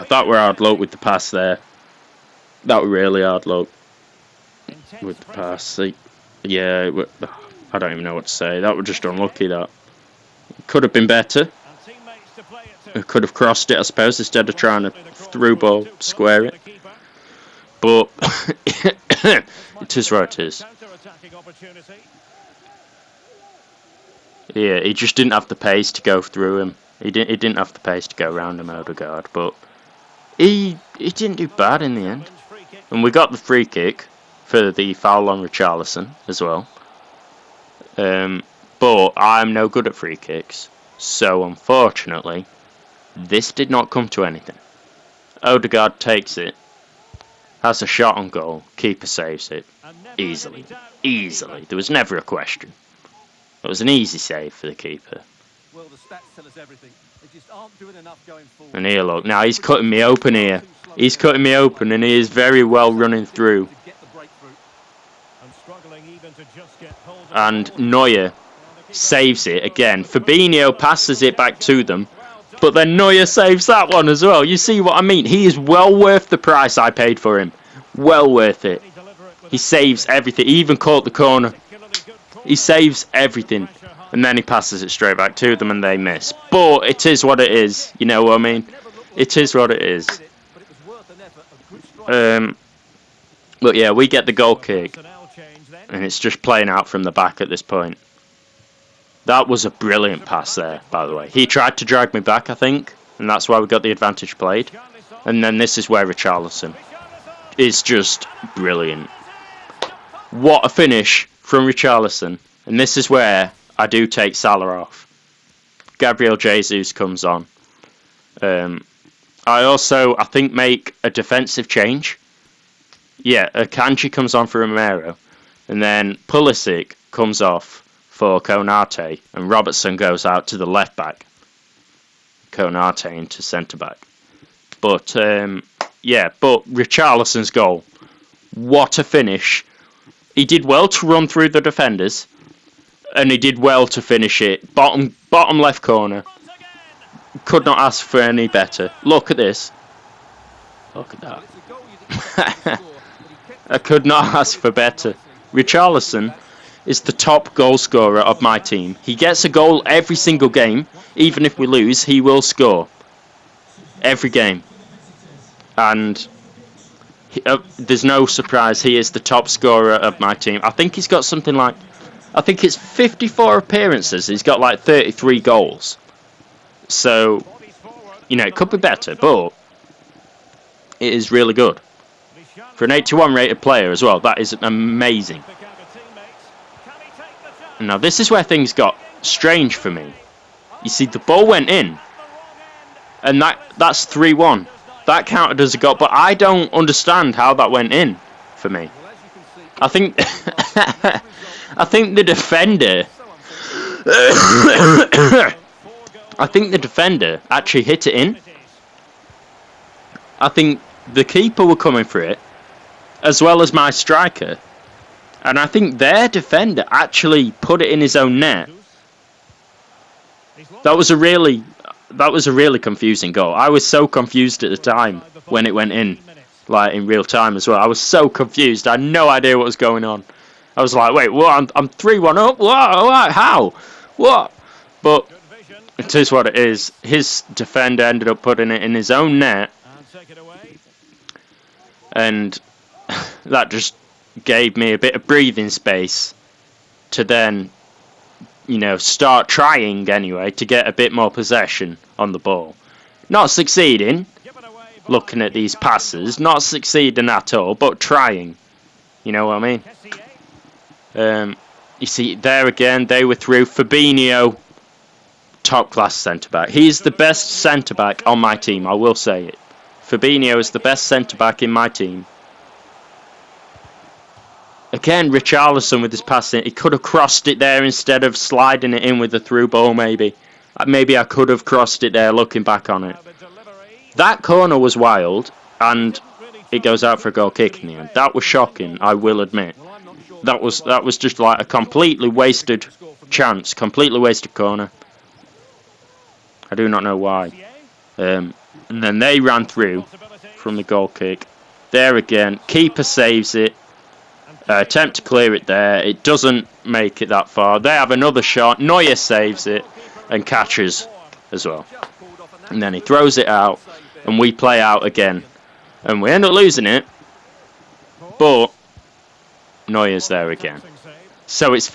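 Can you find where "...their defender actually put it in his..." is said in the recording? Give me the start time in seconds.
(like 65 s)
215 s.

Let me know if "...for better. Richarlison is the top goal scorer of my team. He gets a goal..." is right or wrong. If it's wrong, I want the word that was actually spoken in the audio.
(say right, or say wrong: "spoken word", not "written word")
right.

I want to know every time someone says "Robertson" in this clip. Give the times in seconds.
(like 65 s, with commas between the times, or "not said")
129 s.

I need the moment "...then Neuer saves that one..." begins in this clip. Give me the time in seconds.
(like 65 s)
72 s.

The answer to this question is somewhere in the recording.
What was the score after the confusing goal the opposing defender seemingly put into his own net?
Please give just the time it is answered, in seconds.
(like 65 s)
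194 s.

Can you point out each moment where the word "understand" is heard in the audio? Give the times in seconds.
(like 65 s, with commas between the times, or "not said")
196 s.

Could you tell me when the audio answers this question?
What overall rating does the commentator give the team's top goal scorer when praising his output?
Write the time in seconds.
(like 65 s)
182 s.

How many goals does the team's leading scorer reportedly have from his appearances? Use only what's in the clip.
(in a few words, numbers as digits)
33.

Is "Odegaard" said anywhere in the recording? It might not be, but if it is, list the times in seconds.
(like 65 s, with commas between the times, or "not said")
28 s, 45 s.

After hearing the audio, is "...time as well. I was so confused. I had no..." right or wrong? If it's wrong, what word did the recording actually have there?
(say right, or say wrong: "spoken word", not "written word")
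right.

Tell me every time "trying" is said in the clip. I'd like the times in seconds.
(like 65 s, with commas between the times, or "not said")
14 s, 249 s, 257 s.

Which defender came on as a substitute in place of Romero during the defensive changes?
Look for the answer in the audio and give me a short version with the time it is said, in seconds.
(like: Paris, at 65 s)
Akanji, at 123 s.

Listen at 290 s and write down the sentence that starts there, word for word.
That was that was just like a completely wasted chance, completely wasted corner.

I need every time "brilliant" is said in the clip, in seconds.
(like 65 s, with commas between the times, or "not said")
99 s, 108 s.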